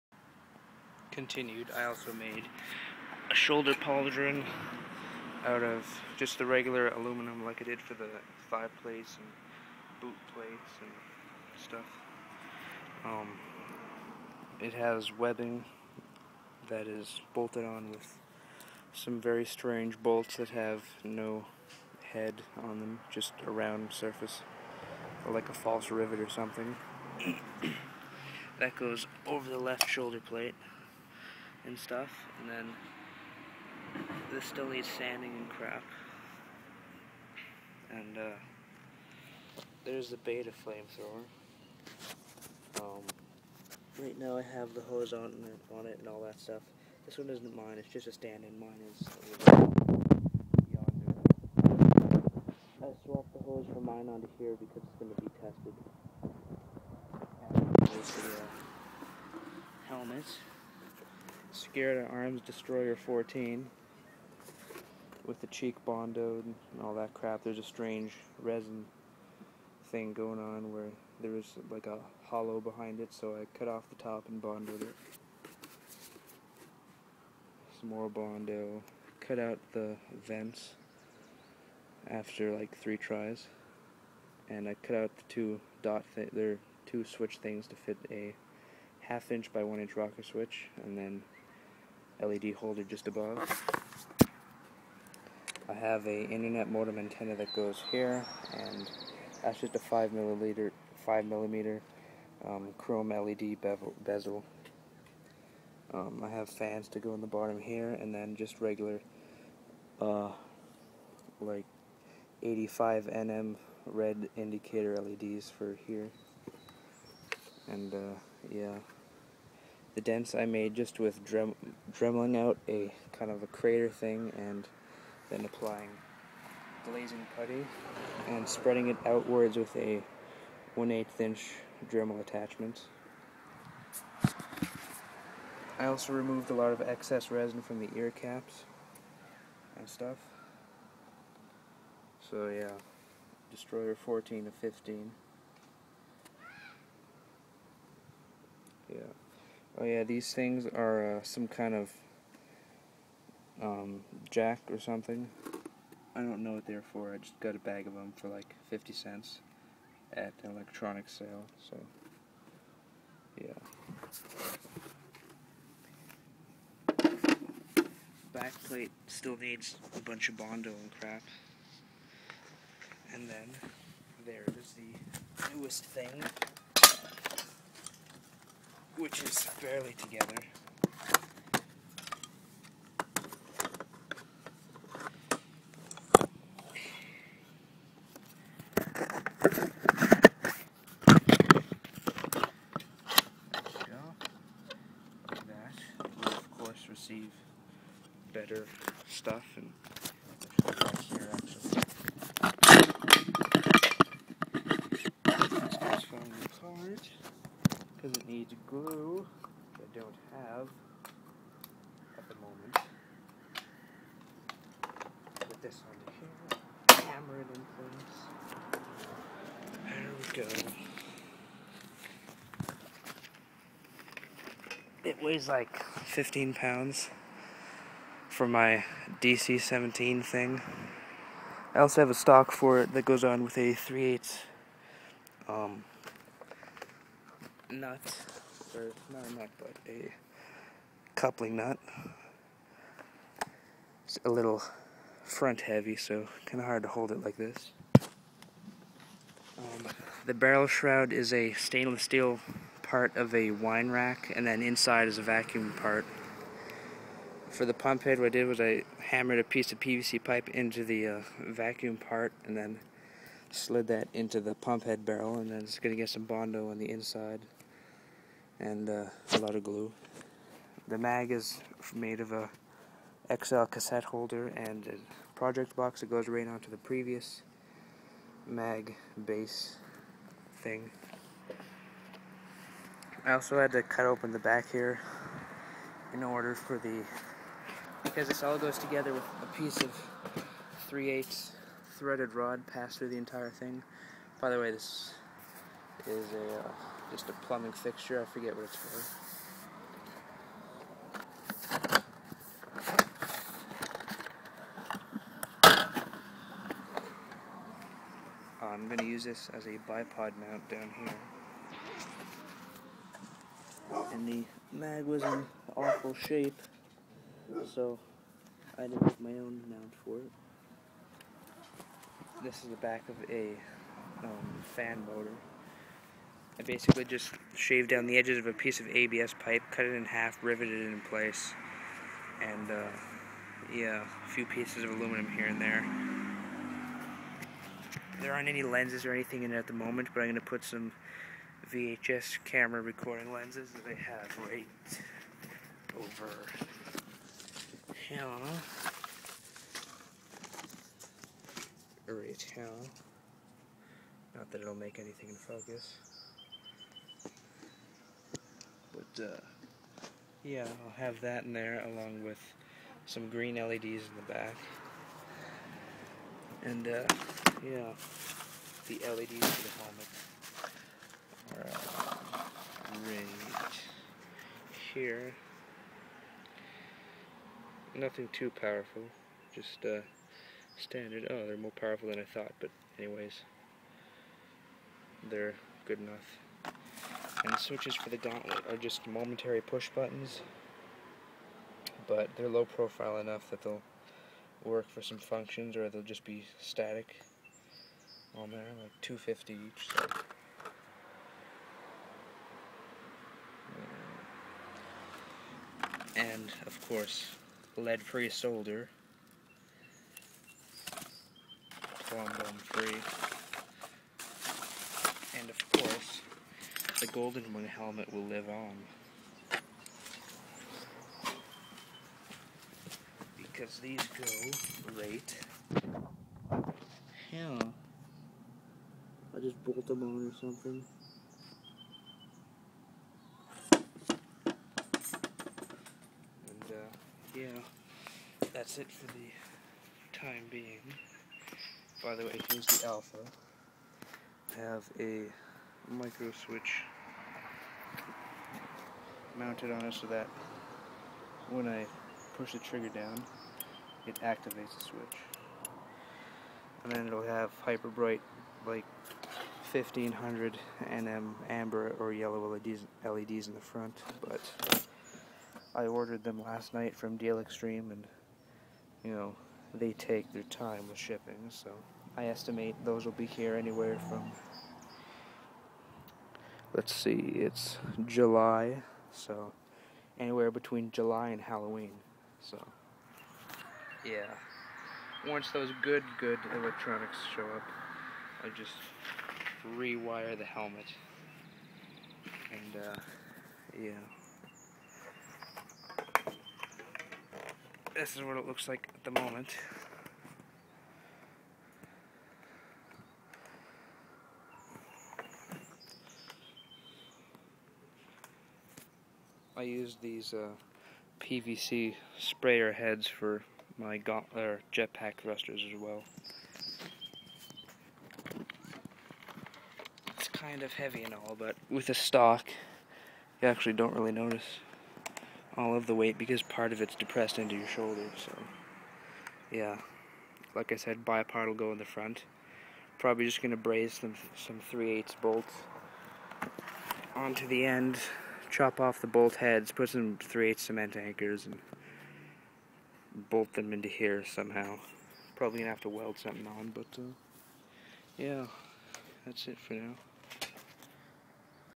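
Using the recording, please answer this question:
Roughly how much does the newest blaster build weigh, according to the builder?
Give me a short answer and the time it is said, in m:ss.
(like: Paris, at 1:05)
15 pounds, at 3:45.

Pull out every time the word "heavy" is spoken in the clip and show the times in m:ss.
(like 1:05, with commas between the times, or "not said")
4:05, 8:40.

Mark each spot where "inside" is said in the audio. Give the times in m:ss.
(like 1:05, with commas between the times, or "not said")
4:14, 4:26.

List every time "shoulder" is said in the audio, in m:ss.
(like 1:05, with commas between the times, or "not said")
0:03, 0:29, 8:47.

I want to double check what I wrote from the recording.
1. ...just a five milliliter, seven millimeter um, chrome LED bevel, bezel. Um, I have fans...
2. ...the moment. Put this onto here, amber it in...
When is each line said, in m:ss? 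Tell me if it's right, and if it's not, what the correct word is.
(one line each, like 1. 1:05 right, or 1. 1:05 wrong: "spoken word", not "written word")
1. 1:39 wrong: "five", not "seven"
2. 3:32 wrong: "hammer", not "amber".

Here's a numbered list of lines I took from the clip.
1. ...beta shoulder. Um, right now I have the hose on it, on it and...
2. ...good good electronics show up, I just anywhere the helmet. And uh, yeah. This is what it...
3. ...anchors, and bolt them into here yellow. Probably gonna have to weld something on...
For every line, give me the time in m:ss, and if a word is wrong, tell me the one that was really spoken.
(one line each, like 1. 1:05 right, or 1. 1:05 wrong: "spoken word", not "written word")
1. 0:40 wrong: "flamethrower", not "shoulder"
2. 8:05 wrong: "rewire", not "anywhere"
3. 9:00 wrong: "somehow", not "yellow".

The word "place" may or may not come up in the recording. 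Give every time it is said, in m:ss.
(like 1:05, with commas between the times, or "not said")
3:38, 5:31.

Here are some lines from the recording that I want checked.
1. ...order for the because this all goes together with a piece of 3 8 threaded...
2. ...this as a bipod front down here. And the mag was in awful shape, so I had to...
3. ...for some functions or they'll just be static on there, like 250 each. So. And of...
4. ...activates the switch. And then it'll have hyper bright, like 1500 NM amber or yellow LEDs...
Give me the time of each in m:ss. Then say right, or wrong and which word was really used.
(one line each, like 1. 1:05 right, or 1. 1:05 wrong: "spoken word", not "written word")
1. 4:46 right
2. 5:09 wrong: "mount", not "front"
3. 6:34 right
4. 7:34 right.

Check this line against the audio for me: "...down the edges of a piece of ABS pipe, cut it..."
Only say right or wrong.
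right.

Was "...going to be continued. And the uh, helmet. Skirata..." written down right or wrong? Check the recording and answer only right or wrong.
wrong.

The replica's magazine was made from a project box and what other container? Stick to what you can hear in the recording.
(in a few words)
XL cassette holder.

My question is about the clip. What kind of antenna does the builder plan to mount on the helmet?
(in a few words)
internet modem antenna.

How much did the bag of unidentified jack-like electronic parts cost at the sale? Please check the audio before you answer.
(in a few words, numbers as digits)
50 cents.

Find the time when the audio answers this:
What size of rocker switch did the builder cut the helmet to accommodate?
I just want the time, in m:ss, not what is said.
1:29.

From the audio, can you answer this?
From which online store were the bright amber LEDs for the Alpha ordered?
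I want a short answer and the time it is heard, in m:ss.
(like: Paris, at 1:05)
Deal Extreme, at 7:47.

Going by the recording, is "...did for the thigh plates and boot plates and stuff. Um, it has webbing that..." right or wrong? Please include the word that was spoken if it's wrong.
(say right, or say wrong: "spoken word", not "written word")
right.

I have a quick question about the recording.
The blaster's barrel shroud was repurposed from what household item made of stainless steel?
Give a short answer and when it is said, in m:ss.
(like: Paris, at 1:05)
wine rack, at 4:13.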